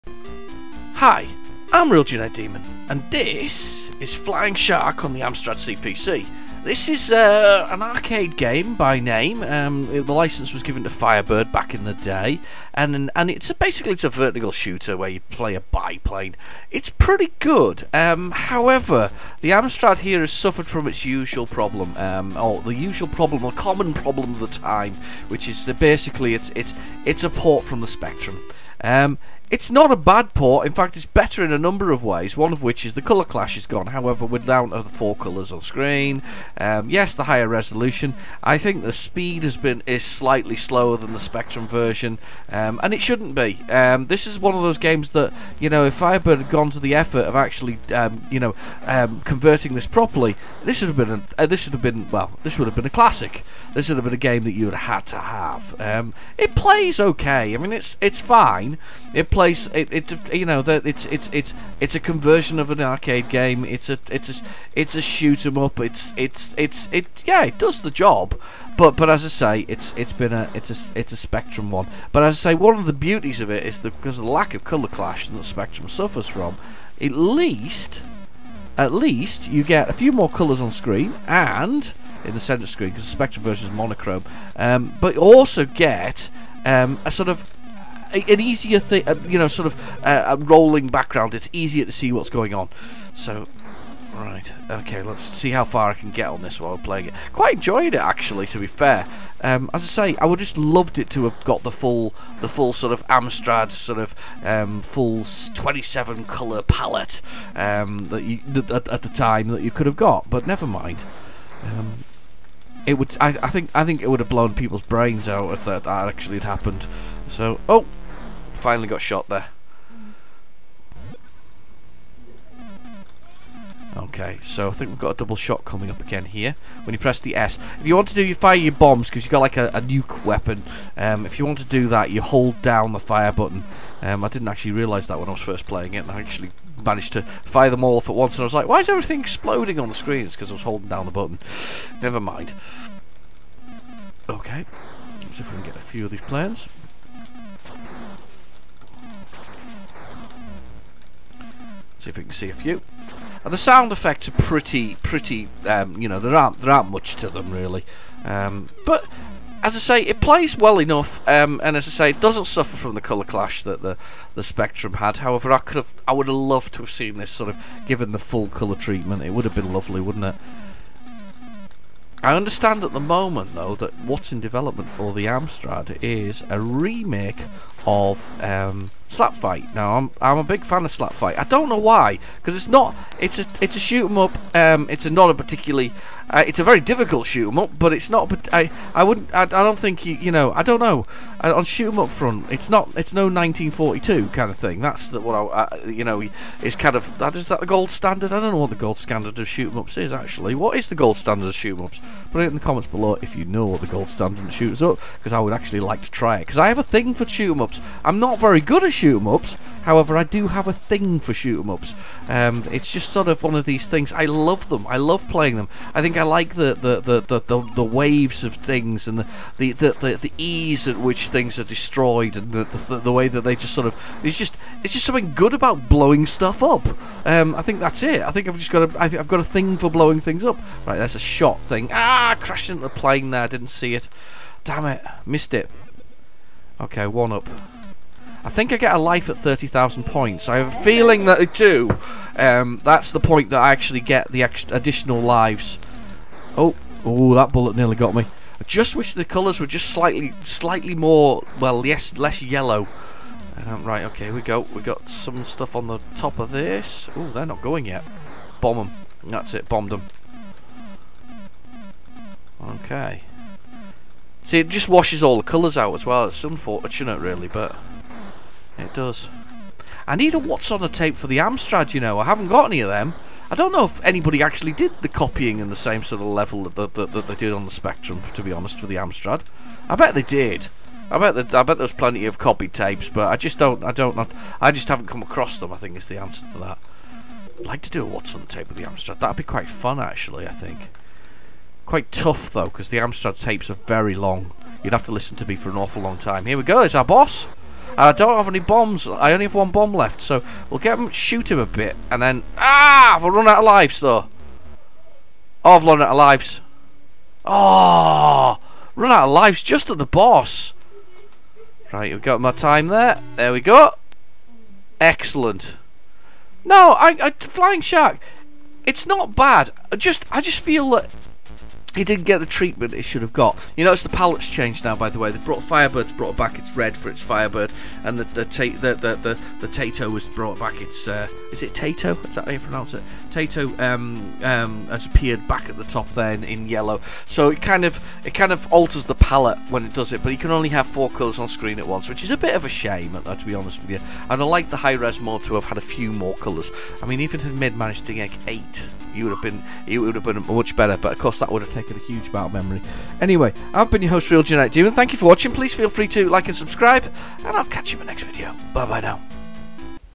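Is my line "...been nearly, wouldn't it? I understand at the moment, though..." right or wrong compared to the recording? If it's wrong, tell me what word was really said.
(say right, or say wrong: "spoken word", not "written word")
wrong: "lovely", not "nearly".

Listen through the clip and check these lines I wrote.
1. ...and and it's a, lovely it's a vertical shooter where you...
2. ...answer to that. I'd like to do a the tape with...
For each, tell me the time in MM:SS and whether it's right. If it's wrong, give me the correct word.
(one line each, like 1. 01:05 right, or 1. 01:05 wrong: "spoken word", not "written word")
1. 00:12 wrong: "basically", not "lovely"
2. 04:46 right.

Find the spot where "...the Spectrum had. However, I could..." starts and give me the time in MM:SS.
02:44.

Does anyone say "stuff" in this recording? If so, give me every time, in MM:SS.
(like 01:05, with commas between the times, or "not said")
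03:46, 04:15.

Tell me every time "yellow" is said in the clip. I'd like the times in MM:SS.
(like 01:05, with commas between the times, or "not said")
04:12, 05:36.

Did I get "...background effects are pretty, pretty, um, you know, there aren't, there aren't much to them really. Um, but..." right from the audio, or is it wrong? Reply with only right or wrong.
wrong.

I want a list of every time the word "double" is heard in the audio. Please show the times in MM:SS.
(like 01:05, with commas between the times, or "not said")
02:05.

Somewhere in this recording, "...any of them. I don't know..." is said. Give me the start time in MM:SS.
04:32.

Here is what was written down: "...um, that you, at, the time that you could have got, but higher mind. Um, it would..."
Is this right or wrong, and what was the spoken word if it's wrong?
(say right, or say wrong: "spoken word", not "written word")
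wrong: "never", not "higher".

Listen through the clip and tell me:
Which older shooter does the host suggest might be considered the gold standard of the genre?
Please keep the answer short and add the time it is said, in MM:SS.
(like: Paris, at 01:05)
1942, at 03:13.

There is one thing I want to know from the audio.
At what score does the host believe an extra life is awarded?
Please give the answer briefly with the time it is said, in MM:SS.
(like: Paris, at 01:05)
30,000 points, at 03:59.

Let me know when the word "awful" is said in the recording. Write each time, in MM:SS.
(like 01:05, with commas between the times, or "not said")
04:55.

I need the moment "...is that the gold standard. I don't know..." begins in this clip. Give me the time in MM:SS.
03:17.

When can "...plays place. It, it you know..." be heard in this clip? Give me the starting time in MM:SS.
00:59.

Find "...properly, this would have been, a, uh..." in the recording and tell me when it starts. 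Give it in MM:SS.
00:49.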